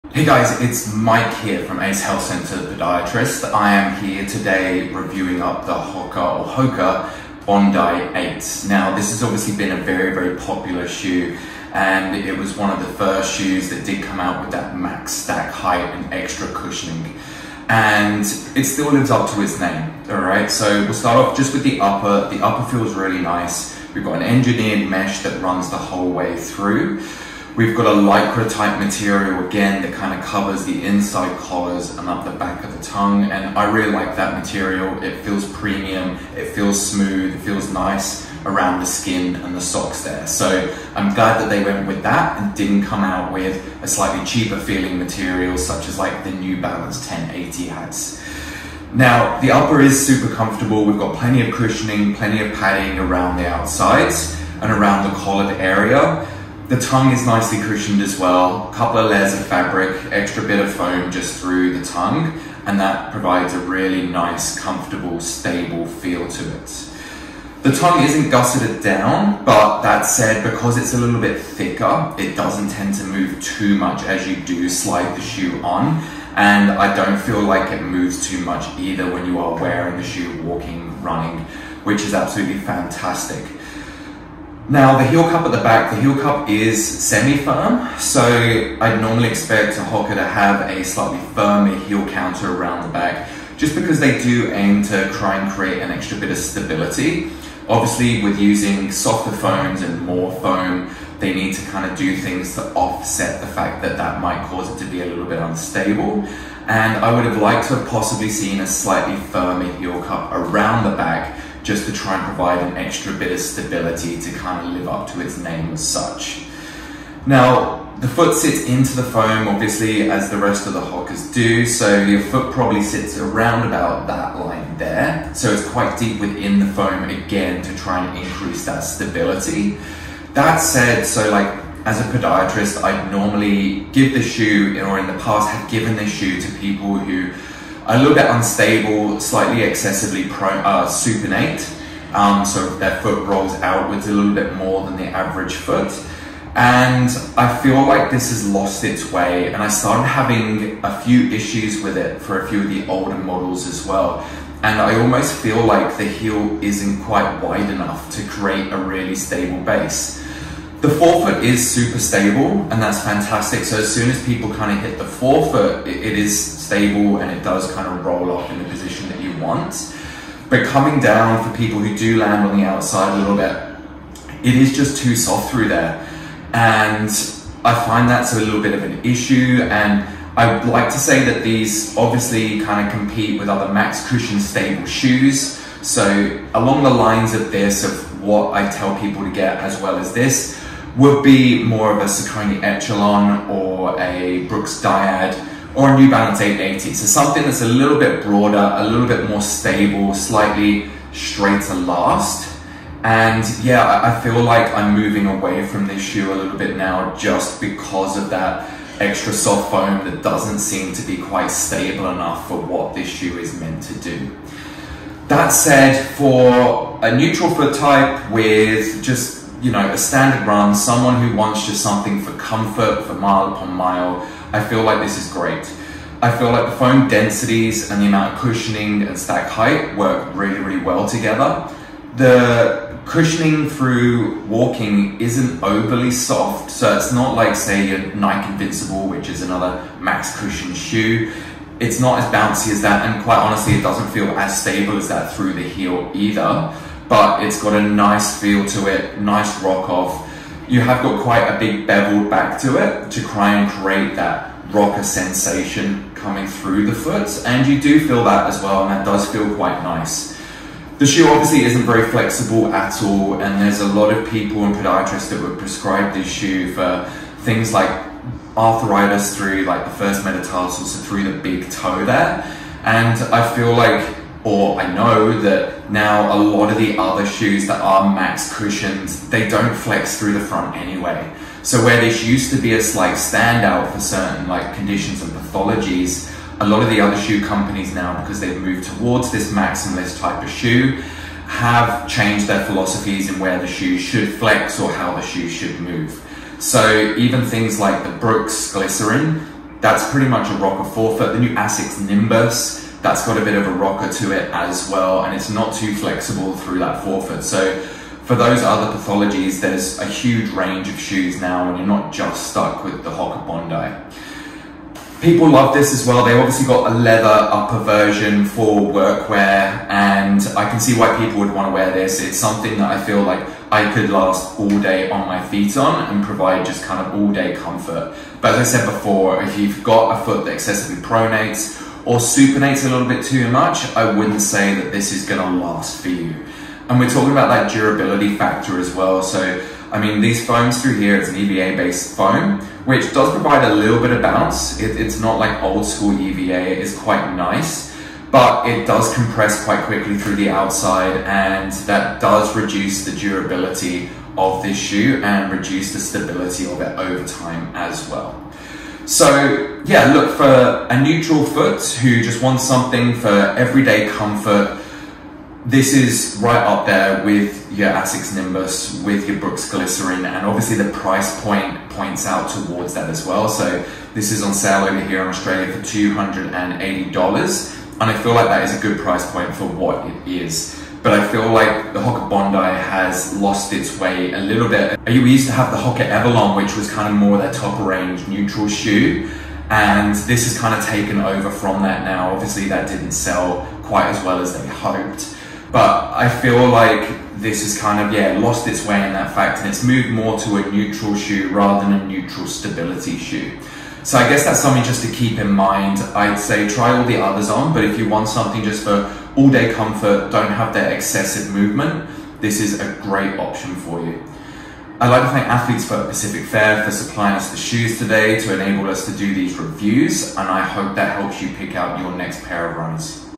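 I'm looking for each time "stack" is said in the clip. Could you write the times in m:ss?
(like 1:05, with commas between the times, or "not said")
0:15, 3:49.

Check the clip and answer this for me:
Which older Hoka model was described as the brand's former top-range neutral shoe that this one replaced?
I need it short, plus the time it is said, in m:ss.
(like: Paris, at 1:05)
Hoka Avalon, at 6:25.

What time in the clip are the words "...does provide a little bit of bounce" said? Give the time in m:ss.
5:43.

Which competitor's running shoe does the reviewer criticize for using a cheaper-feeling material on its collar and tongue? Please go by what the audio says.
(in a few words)
New Balance 1080.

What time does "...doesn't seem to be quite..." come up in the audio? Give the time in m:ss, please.
3:30.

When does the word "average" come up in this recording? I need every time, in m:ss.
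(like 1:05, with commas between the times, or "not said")
2:25.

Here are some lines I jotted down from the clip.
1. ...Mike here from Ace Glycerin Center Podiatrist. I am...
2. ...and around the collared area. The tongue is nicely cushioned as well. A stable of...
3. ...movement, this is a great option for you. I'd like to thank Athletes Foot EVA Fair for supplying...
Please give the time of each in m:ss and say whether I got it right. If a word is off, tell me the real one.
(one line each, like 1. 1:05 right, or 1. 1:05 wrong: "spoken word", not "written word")
1. 0:00 wrong: "Health", not "Glycerin"
2. 0:54 wrong: "couple", not "stable"
3. 6:51 wrong: "Pacific", not "EVA".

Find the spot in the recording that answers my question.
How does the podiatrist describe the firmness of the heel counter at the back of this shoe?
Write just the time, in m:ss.
1:26.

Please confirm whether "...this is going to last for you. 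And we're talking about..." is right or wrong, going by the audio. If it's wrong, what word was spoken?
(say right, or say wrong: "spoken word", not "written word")
right.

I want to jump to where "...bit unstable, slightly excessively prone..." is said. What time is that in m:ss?
2:18.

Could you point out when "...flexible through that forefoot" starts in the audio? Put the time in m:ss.
5:05.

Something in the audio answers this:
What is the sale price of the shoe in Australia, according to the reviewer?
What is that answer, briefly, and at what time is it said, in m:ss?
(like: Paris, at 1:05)
$280, at 6:15.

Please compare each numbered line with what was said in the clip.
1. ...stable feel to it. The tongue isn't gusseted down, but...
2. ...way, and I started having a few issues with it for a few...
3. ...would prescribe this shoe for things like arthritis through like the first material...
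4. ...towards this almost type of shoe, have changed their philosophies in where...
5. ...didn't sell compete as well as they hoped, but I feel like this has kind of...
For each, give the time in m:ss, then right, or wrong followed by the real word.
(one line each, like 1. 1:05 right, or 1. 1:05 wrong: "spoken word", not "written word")
1. 1:05 right
2. 2:29 right
3. 4:25 wrong: "metatarsal", not "material"
4. 4:48 wrong: "maximalist", not "almost"
5. 6:32 wrong: "quite", not "compete".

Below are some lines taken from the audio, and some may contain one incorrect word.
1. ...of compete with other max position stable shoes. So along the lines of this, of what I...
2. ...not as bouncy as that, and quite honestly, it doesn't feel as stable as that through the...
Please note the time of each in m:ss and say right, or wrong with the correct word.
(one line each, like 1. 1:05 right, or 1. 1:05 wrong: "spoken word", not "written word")
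1. 3:02 wrong: "cushion", not "position"
2. 4:01 right.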